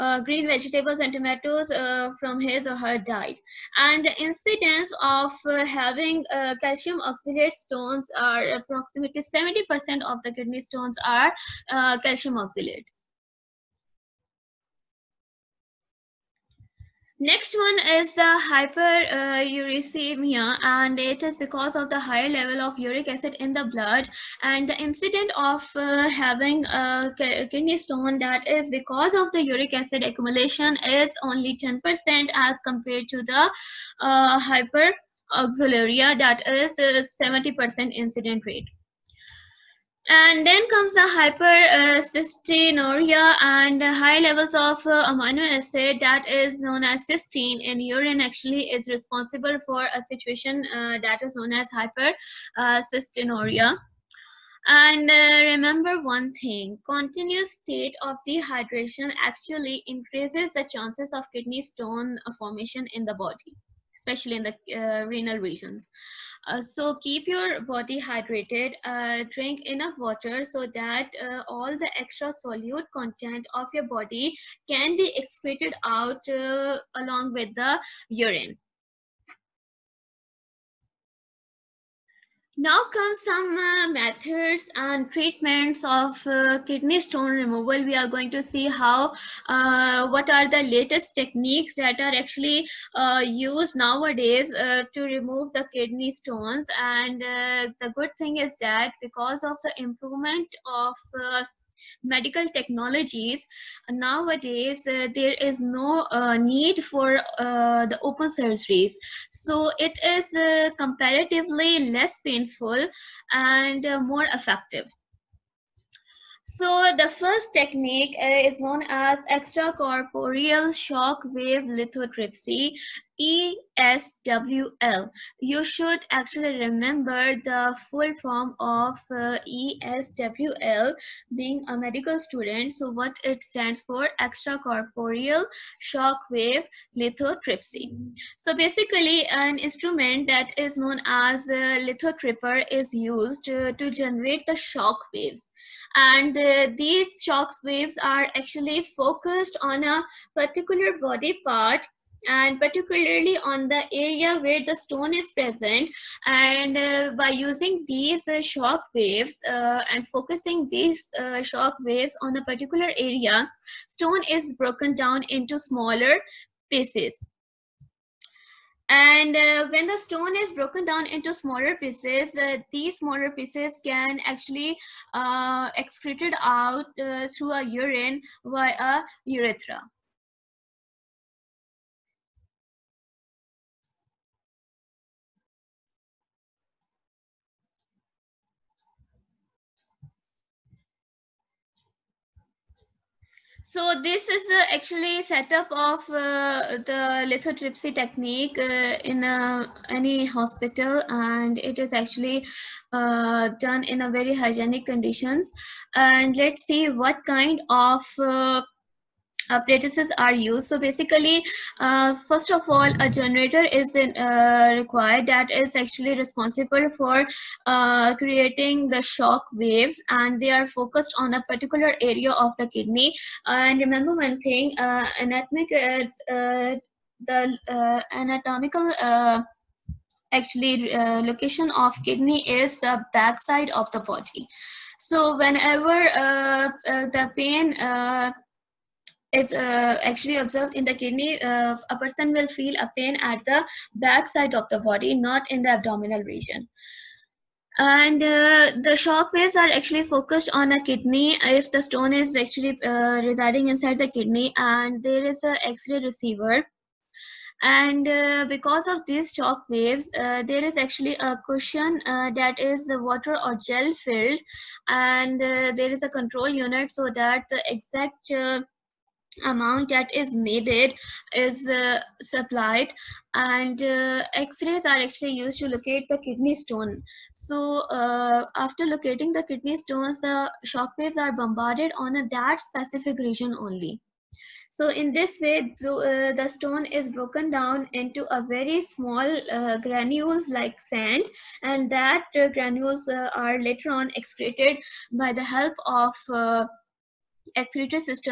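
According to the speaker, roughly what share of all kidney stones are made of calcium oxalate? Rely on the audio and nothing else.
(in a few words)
70%.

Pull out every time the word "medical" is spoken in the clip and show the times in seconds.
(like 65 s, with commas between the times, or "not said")
102 s, 131 s.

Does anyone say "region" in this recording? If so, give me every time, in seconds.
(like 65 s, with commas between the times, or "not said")
65 s, 246 s, 283 s.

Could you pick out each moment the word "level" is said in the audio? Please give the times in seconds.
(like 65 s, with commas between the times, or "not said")
22 s, 44 s.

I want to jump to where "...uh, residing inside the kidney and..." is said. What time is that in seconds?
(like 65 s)
252 s.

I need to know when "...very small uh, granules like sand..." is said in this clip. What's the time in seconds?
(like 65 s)
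288 s.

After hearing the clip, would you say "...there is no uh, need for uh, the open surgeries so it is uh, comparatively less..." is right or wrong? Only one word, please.
right.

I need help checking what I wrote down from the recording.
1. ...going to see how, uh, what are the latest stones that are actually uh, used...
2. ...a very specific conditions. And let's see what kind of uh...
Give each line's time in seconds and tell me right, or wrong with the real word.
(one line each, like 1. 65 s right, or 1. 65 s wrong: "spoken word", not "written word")
1. 88 s wrong: "techniques", not "stones"
2. 204 s wrong: "hygienic", not "specific".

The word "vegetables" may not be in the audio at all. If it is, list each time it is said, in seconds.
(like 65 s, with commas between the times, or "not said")
0 s.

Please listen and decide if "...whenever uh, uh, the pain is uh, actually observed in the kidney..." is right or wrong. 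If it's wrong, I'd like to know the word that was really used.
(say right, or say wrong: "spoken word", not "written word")
right.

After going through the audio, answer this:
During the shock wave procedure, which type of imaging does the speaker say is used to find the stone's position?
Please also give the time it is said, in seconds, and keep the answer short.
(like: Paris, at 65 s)
X-rays, at 274 s.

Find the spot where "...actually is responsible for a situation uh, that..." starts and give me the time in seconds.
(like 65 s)
48 s.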